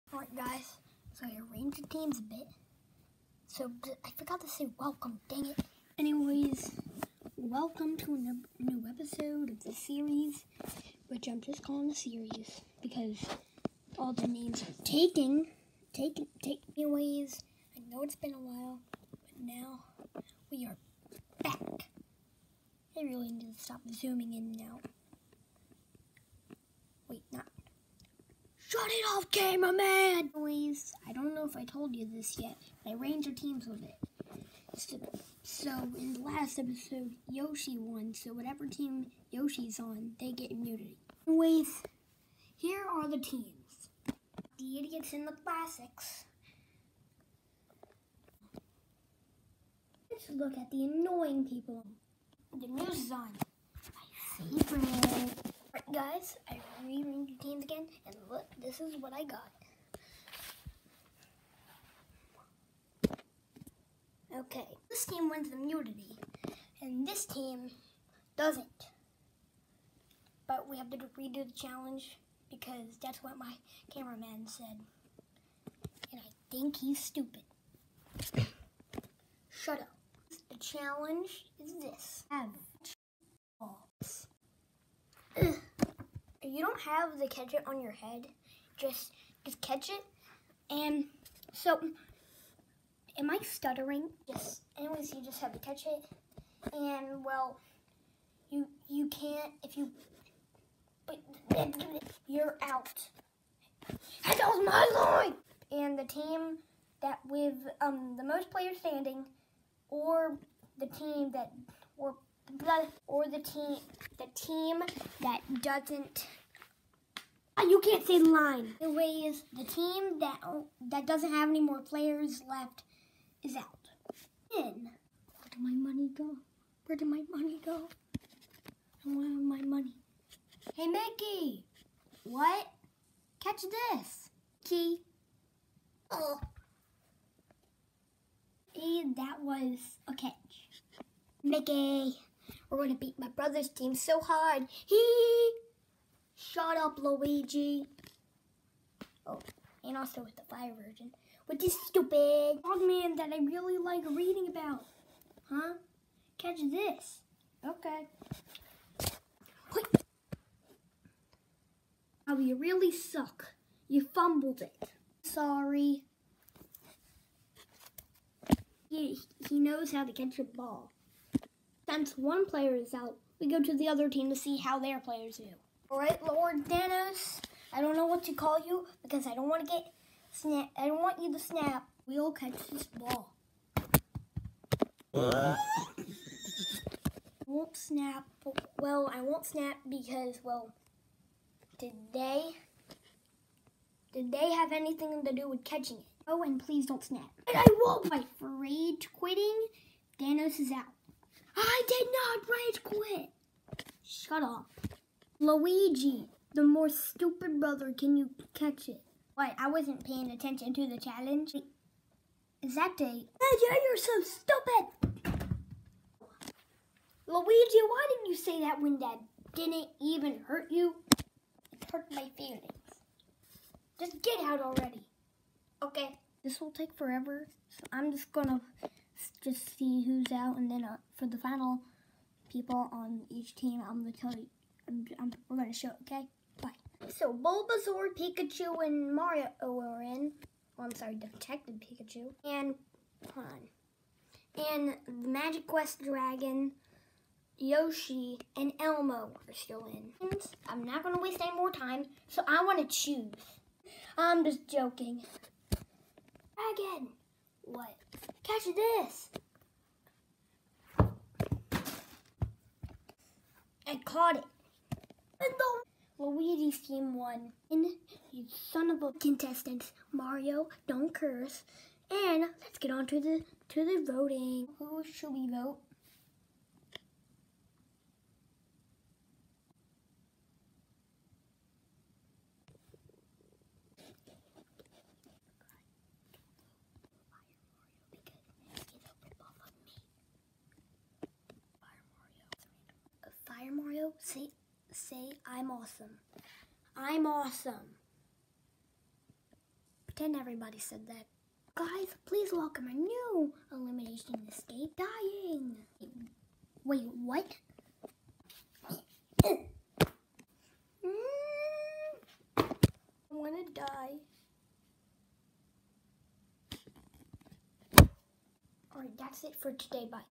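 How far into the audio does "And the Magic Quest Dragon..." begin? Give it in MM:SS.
04:04.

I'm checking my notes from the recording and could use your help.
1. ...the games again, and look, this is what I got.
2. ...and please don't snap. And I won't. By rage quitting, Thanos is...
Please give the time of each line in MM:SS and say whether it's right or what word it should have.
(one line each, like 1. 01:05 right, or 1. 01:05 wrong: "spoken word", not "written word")
1. 00:57 right
2. 03:16 right.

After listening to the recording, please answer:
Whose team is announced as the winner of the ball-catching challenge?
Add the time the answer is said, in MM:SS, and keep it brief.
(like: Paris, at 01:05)
Luigi's team, at 04:26.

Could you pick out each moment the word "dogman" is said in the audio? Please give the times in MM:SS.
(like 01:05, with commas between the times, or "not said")
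02:32.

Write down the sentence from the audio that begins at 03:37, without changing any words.
Luigi, why did not you say that when Dad didn't even hurt you?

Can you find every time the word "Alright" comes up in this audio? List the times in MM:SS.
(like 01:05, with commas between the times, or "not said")
02:55, 05:18.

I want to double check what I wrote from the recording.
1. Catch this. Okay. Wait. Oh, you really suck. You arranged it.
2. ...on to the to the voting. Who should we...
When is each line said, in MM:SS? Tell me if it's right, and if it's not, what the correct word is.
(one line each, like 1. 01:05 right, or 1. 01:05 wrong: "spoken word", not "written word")
1. 02:36 wrong: "fumbled", not "arranged"
2. 04:32 right.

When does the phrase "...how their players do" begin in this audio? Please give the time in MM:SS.
02:54.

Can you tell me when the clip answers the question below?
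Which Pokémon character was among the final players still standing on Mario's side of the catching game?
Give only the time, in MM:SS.
03:57.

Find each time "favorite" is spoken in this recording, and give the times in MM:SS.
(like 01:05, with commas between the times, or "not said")
00:54.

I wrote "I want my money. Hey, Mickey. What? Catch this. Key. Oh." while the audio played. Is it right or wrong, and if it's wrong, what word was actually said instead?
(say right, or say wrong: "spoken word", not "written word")
right.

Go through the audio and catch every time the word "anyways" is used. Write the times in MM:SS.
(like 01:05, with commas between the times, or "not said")
00:05, 00:16, 00:41, 01:34.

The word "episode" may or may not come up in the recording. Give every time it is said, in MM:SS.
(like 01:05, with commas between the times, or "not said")
00:08, 00:36.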